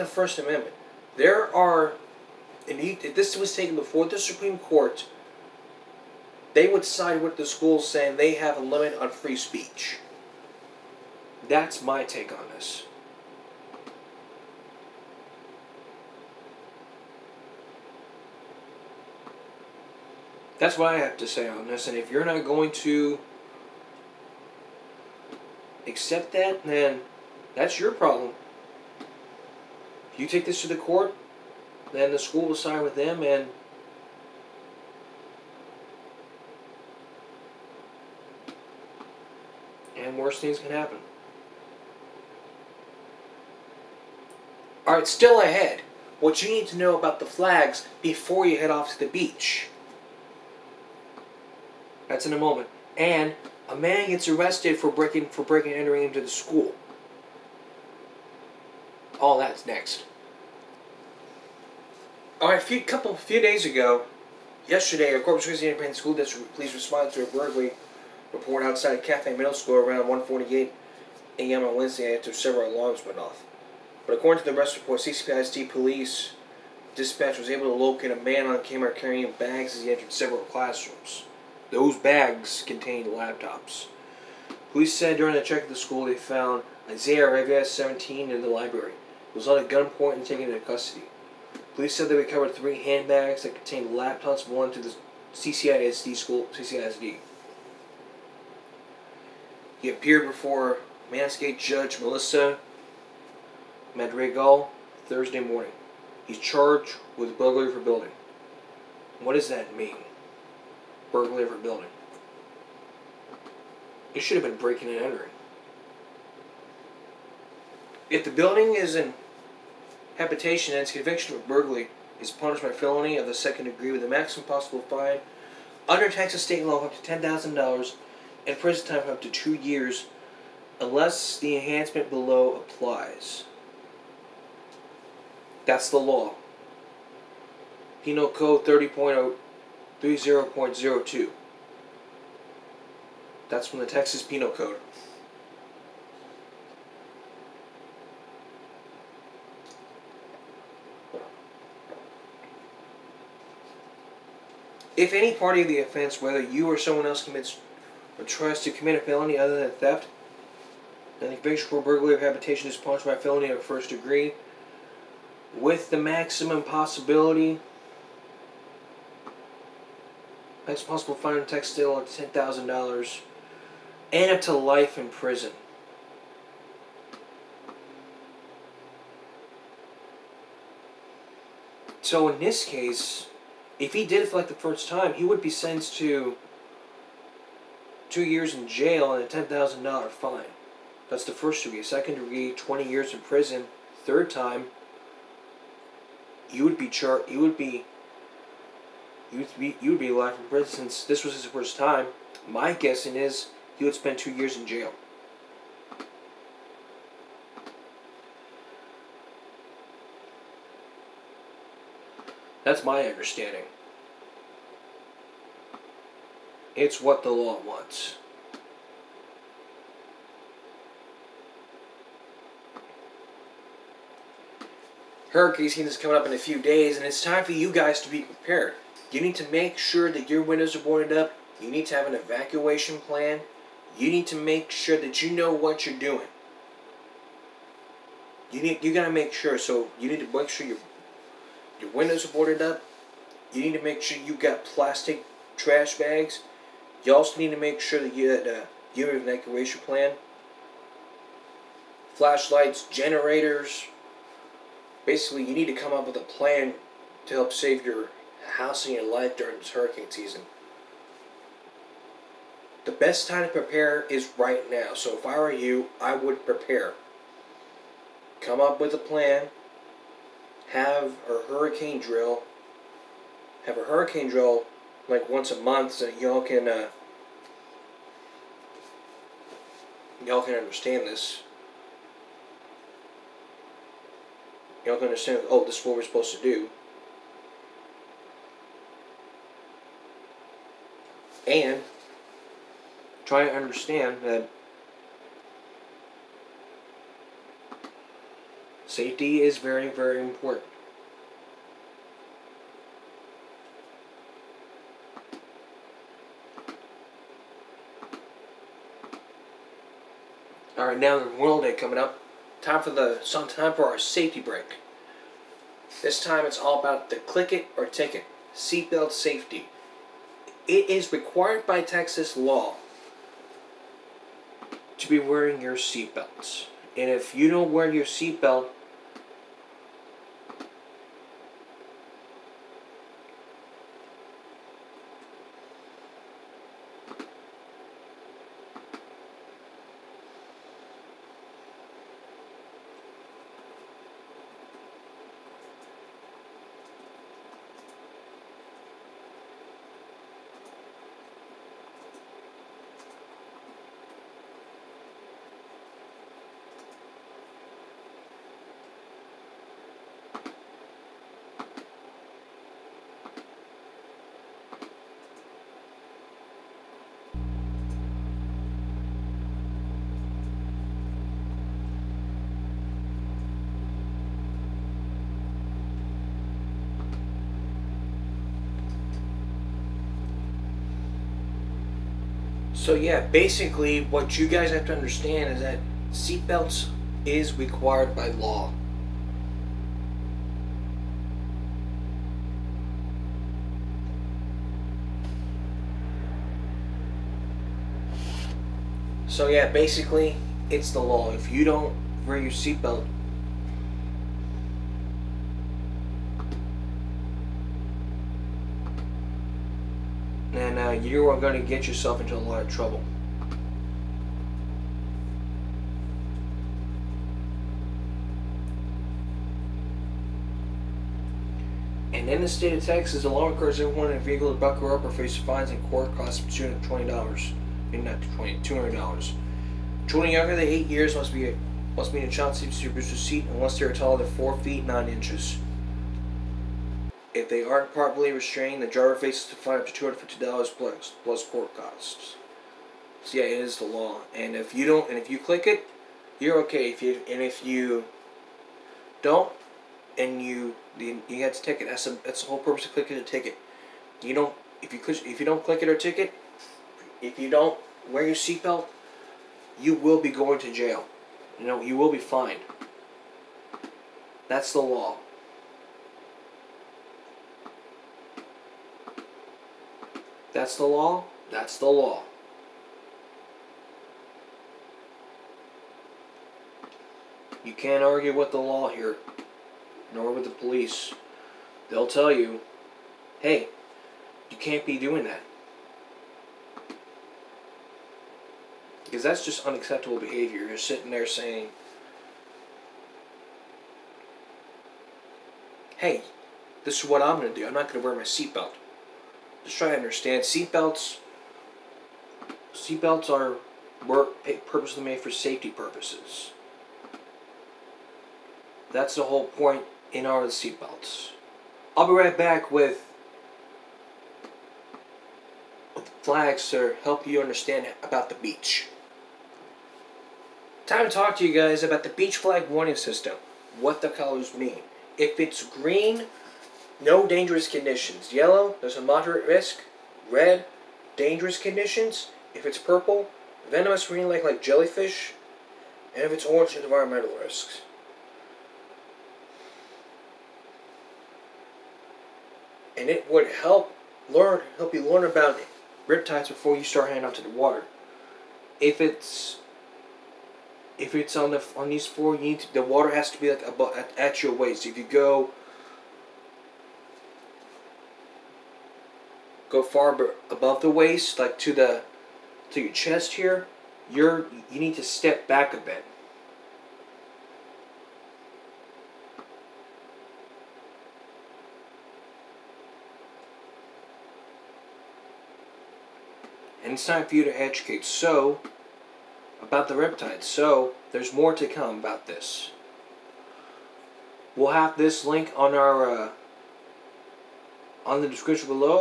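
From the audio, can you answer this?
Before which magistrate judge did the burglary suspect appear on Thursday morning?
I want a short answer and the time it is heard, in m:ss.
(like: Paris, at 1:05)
Melissa Madrigal, at 1:41.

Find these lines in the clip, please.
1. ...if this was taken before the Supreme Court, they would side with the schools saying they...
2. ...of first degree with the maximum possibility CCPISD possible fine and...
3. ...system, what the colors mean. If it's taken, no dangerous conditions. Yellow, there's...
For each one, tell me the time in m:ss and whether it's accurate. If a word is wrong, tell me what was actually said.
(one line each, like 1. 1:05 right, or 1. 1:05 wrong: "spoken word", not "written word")
1. 0:02 right
2. 2:43 wrong: "Next", not "CCPISD"
3. 8:42 wrong: "green", not "taken".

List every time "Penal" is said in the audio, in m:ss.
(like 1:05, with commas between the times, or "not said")
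2:18, 2:24.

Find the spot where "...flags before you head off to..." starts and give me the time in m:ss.
0:47.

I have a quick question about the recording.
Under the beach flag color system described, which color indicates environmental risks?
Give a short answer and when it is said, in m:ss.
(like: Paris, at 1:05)
Orange, at 8:56.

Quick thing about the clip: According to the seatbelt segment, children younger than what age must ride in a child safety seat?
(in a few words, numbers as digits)
8.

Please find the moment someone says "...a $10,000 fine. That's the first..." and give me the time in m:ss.
3:09.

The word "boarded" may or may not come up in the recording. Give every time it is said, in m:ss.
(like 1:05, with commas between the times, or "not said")
3:50, 4:02.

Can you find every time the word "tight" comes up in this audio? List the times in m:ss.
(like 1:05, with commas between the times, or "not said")
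not said.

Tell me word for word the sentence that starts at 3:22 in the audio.
My guessing is he would spend two years in jail.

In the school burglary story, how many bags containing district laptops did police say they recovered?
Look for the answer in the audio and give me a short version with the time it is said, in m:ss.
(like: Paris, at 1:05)
3, at 1:32.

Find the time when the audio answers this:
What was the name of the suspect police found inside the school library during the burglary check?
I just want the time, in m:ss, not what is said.
1:26.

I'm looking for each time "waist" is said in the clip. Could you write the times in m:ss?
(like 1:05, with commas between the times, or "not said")
9:14, 9:20.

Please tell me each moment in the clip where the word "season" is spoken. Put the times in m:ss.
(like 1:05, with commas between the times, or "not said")
3:45, 4:20.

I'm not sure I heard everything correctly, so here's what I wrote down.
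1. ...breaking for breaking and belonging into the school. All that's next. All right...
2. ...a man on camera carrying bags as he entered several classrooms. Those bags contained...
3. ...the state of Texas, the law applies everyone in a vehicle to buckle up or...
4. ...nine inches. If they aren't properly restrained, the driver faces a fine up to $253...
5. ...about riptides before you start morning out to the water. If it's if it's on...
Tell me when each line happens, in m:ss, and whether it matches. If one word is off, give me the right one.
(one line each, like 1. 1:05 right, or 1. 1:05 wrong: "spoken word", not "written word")
1. 0:54 wrong: "entering", not "belonging"
2. 1:18 right
3. 7:02 wrong: "requires", not "applies"
4. 7:14 wrong: "250", not "253"
5. 9:05 wrong: "heading", not "morning".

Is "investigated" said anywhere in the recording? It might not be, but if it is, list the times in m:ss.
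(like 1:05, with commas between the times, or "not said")
not said.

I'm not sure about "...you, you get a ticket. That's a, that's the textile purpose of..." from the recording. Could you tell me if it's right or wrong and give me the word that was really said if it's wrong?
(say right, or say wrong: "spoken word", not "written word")
wrong: "whole", not "textile".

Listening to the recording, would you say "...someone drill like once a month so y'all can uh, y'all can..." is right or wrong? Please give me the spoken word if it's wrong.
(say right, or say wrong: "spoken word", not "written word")
wrong: "hurricane", not "someone".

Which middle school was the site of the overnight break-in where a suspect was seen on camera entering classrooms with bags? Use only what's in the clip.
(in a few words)
Kaffie Middle School.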